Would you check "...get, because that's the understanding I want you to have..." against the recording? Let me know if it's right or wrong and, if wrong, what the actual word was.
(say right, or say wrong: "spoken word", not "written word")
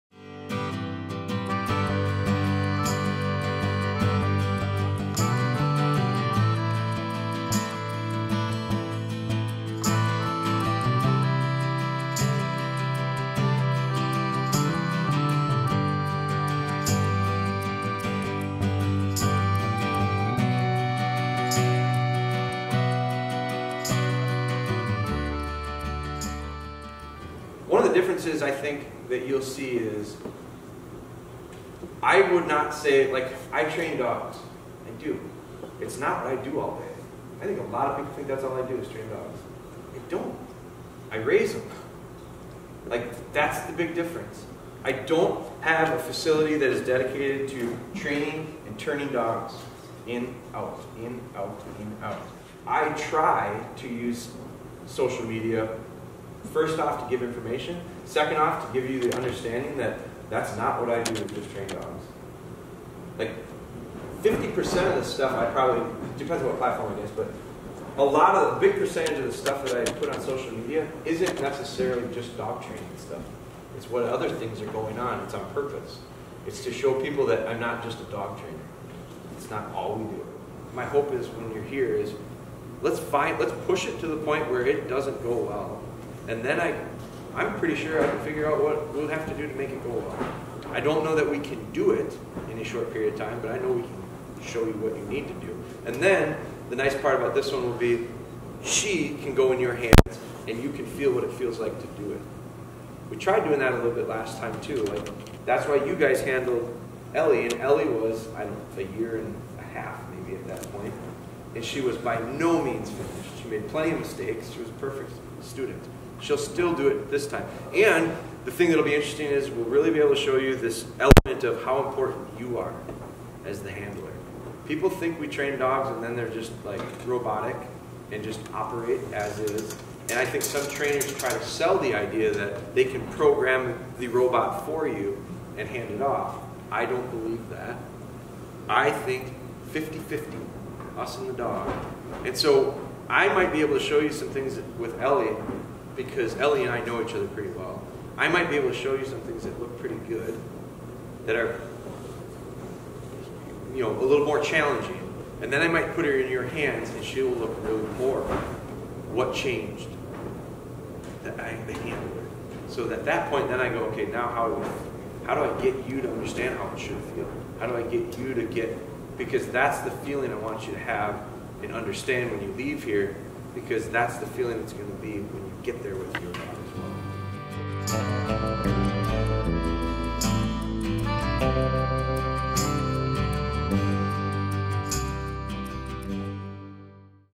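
wrong: "feeling", not "understanding".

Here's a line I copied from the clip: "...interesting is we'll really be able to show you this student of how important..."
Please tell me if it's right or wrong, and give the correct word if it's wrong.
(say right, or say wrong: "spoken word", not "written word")
wrong: "element", not "student".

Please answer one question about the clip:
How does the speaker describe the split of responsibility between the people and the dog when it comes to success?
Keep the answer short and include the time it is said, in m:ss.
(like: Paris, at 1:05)
50-50, at 2:19.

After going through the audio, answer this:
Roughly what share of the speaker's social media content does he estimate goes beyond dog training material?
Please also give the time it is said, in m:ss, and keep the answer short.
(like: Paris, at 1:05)
50%, at 1:04.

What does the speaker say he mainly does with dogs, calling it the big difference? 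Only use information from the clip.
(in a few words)
Raise them.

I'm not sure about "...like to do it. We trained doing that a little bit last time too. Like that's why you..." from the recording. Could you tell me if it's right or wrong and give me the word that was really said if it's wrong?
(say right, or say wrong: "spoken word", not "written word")
wrong: "tried", not "trained".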